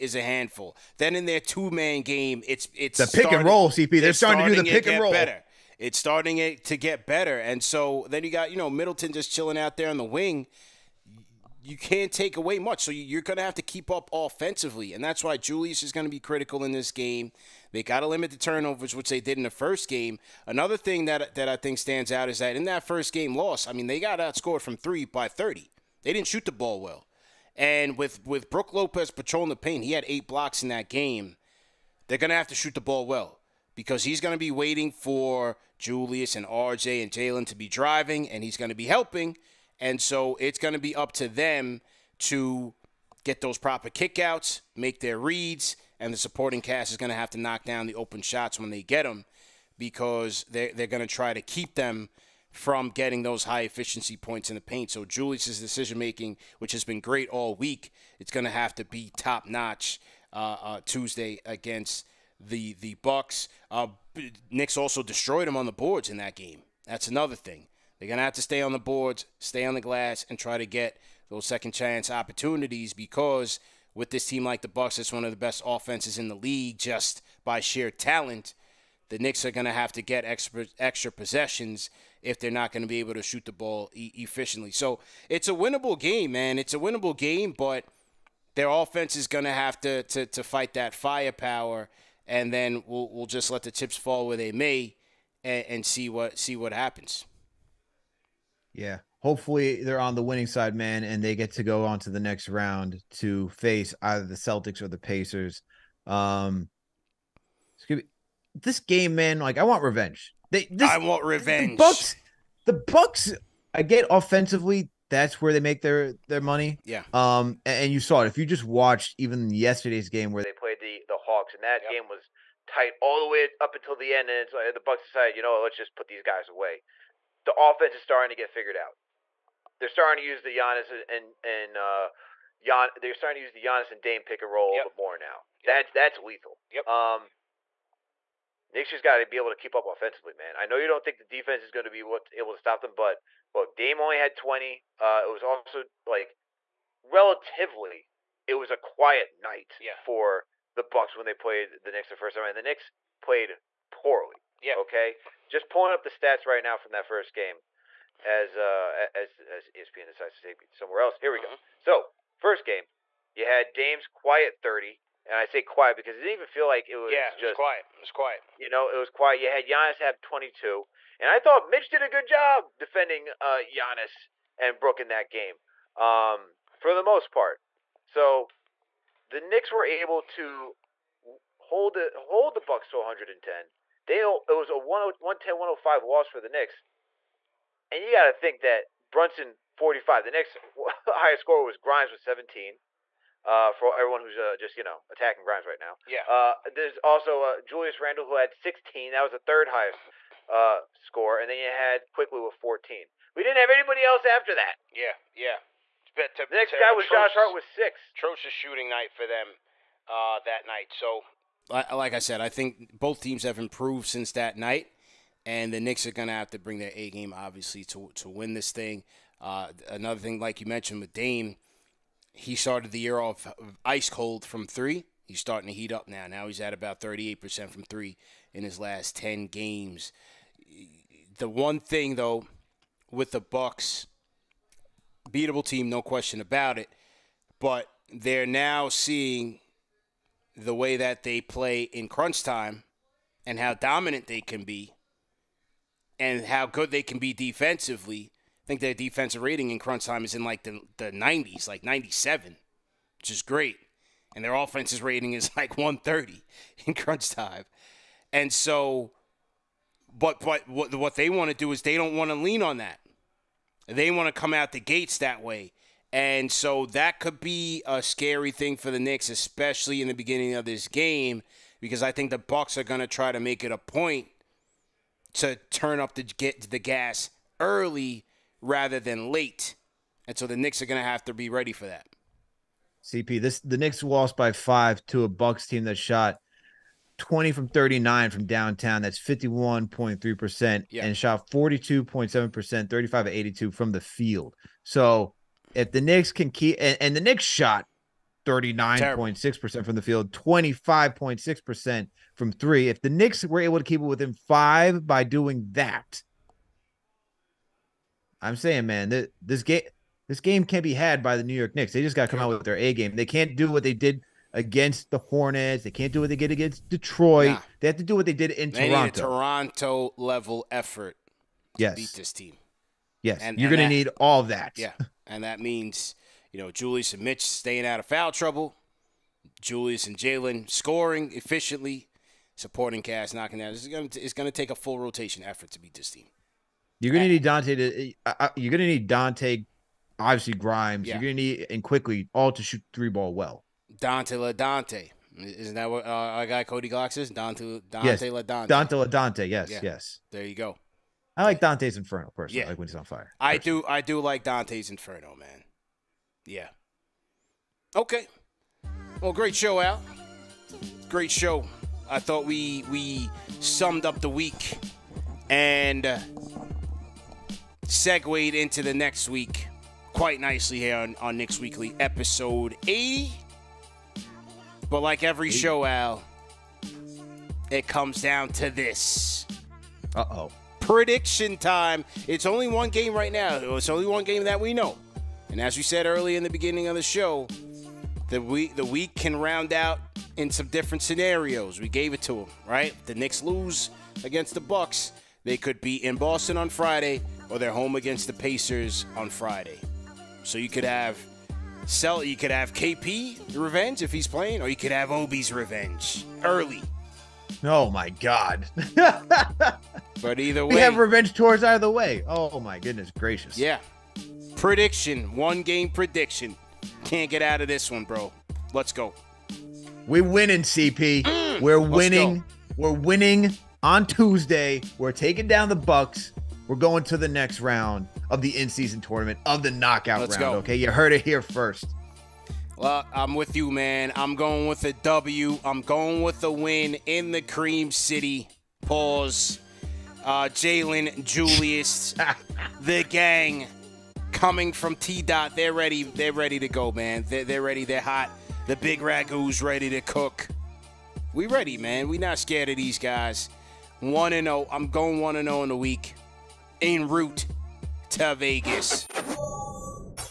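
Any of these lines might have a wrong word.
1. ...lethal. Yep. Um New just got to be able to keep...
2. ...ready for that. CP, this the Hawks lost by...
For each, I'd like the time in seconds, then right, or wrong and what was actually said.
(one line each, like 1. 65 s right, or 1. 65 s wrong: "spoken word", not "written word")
1. 136 s wrong: "Knicks", not "New"
2. 281 s wrong: "Knicks", not "Hawks".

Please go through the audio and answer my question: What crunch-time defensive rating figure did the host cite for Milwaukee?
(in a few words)
97.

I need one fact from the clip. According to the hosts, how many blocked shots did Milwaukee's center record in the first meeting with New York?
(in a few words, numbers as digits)
8.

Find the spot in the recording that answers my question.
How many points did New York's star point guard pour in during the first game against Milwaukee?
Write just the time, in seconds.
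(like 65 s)
189 s.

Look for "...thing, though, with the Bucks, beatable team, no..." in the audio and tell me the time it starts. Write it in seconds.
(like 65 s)
231 s.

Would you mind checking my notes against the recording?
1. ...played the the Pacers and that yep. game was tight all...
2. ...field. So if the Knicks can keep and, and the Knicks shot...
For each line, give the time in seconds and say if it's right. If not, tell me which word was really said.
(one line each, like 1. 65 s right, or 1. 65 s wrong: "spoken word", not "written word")
1. 120 s wrong: "Hawks", not "Pacers"
2. 293 s right.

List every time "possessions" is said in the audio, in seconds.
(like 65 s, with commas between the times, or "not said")
81 s.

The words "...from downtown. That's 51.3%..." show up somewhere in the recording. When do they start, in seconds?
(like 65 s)
288 s.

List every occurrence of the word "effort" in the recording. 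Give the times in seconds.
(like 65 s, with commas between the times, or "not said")
320 s, 335 s.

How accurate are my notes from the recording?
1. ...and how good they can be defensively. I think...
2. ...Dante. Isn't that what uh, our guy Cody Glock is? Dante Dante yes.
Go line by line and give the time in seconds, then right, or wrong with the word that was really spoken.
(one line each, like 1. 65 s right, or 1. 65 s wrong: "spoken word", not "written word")
1. 246 s right
2. 344 s right.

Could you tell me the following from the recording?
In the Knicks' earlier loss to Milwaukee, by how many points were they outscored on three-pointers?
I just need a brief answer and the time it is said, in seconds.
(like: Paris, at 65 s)
30, at 25 s.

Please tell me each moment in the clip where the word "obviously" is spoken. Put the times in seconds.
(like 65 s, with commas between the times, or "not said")
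217 s, 340 s.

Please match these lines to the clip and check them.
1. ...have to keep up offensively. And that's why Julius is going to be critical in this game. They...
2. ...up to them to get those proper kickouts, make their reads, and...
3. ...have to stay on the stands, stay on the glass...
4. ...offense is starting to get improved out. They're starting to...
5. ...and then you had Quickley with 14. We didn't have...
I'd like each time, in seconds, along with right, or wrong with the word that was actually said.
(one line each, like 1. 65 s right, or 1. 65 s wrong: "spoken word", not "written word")
1. 13 s right
2. 40 s right
3. 68 s wrong: "boards", not "stands"
4. 127 s wrong: "figured", not "improved"
5. 201 s right.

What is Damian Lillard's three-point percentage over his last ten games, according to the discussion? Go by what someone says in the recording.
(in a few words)
38%.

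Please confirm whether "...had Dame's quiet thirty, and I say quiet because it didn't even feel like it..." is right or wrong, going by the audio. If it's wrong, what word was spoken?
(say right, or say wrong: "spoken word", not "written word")
right.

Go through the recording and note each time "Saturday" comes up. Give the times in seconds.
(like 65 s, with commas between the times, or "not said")
not said.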